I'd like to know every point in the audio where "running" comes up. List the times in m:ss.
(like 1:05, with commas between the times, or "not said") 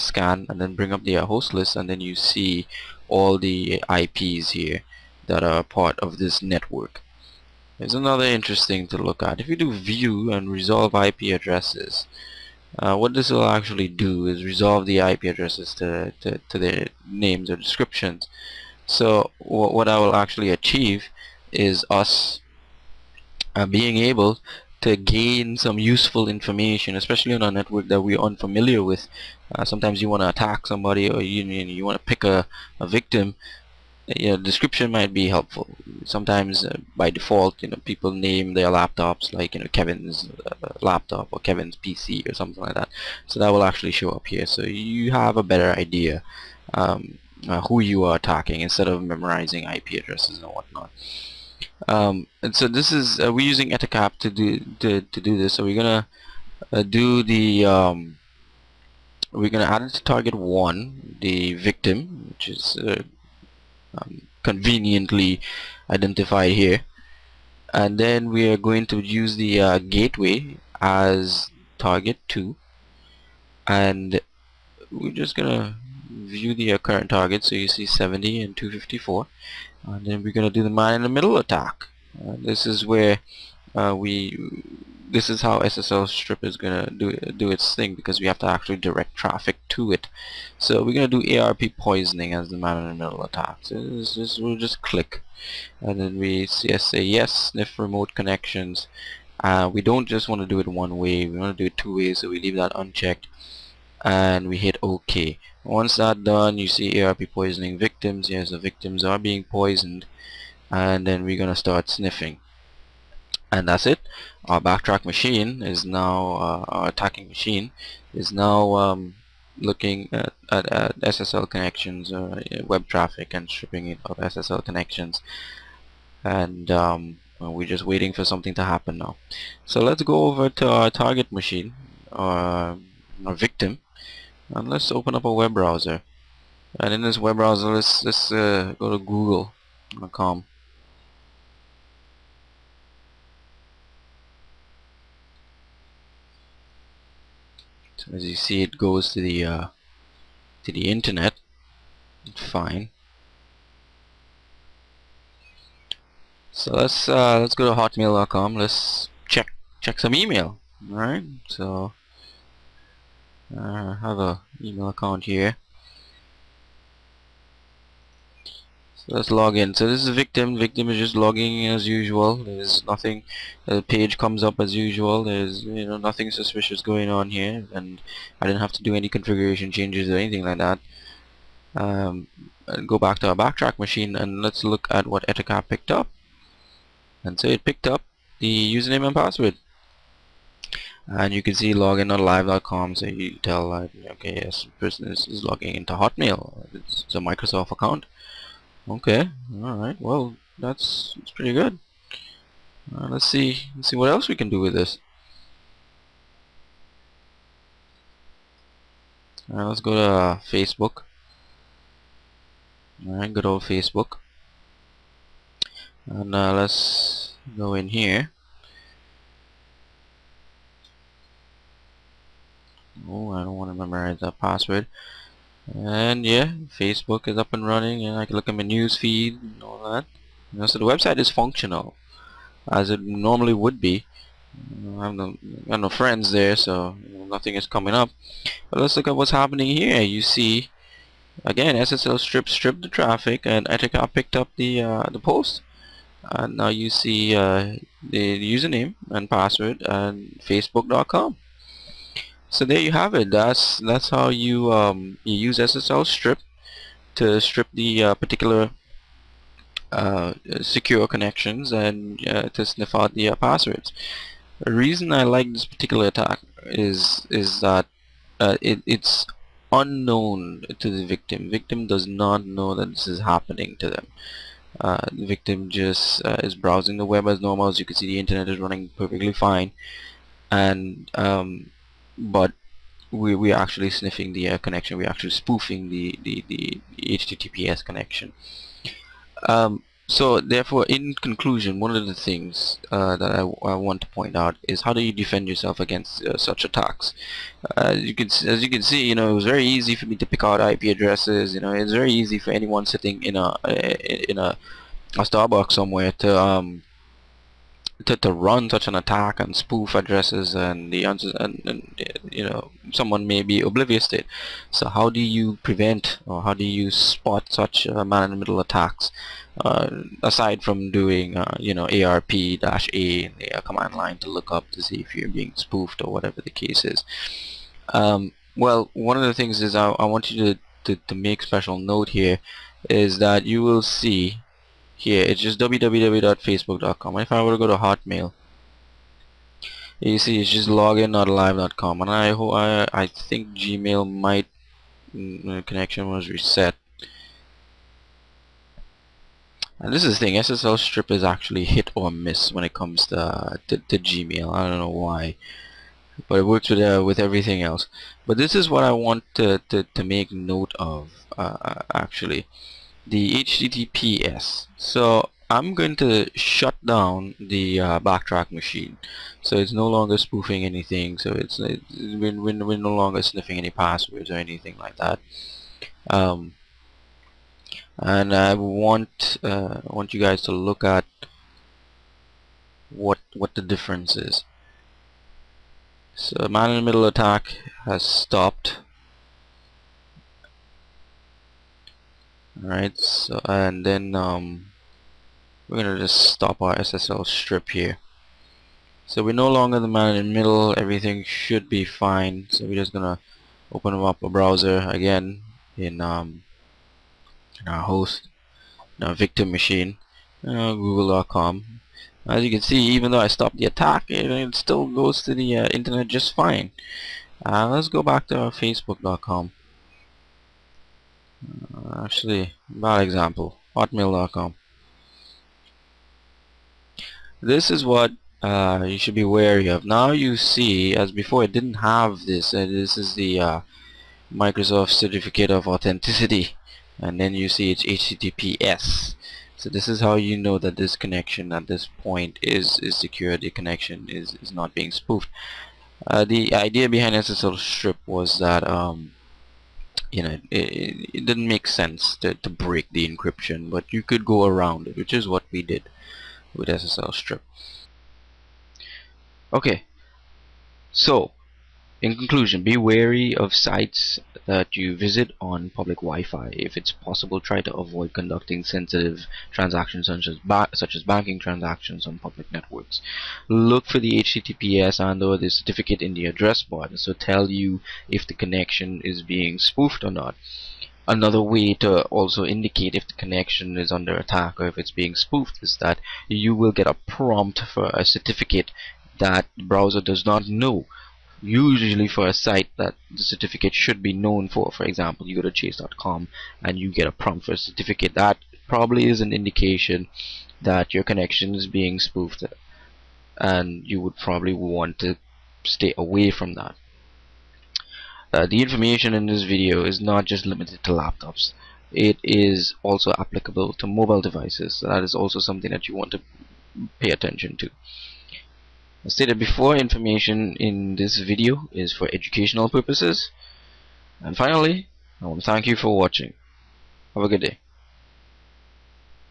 3:47, 4:38.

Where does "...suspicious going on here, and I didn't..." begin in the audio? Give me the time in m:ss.
2:56.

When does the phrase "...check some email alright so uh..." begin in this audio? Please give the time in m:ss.
2:39.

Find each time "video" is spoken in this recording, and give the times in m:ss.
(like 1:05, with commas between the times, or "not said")
8:29, 8:41.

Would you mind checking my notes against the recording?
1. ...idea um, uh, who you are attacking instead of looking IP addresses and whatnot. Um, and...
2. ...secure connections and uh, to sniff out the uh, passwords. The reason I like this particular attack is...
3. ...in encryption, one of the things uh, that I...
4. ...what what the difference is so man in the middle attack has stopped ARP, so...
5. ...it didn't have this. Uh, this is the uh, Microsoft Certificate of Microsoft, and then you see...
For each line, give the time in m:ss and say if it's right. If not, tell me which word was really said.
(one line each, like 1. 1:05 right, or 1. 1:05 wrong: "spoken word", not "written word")
1. 0:45 wrong: "memorizing", not "looking"
2. 4:20 right
3. 4:50 wrong: "conclusion", not "encryption"
4. 6:22 wrong: "Alright", not "ARP"
5. 7:11 wrong: "Authenticity", not "Microsoft".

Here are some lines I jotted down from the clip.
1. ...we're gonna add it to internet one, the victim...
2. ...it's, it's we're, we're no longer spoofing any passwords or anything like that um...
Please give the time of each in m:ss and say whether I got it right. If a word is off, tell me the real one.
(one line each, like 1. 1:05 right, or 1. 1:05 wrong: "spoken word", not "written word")
1. 0:59 wrong: "target", not "internet"
2. 6:11 wrong: "sniffing", not "spoofing".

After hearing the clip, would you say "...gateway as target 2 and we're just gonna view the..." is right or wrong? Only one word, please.
right.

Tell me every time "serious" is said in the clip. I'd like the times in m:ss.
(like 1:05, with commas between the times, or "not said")
not said.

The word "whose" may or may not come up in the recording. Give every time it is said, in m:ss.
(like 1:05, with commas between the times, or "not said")
not said.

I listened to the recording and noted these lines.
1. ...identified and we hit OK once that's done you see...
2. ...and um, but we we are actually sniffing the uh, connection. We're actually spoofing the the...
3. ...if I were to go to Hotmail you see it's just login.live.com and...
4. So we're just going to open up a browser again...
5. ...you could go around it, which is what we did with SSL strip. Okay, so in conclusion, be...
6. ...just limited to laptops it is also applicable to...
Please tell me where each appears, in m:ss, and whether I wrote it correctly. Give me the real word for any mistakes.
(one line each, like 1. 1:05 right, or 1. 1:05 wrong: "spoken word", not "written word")
1. 1:42 wrong: "unchecked", not "identified"
2. 4:40 right
3. 5:37 right
4. 6:42 right
5. 7:33 right
6. 8:30 right.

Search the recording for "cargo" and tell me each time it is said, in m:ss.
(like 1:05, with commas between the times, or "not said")
not said.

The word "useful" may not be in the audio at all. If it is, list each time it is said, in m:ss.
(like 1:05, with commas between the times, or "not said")
0:25.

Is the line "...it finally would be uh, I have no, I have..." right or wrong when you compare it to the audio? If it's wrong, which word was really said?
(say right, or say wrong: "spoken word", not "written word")
wrong: "normally", not "finally".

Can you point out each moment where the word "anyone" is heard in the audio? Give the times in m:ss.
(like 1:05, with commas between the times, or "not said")
5:02.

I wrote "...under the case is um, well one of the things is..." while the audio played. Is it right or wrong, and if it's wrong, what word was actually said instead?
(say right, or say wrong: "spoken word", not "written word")
wrong: "whatever", not "under".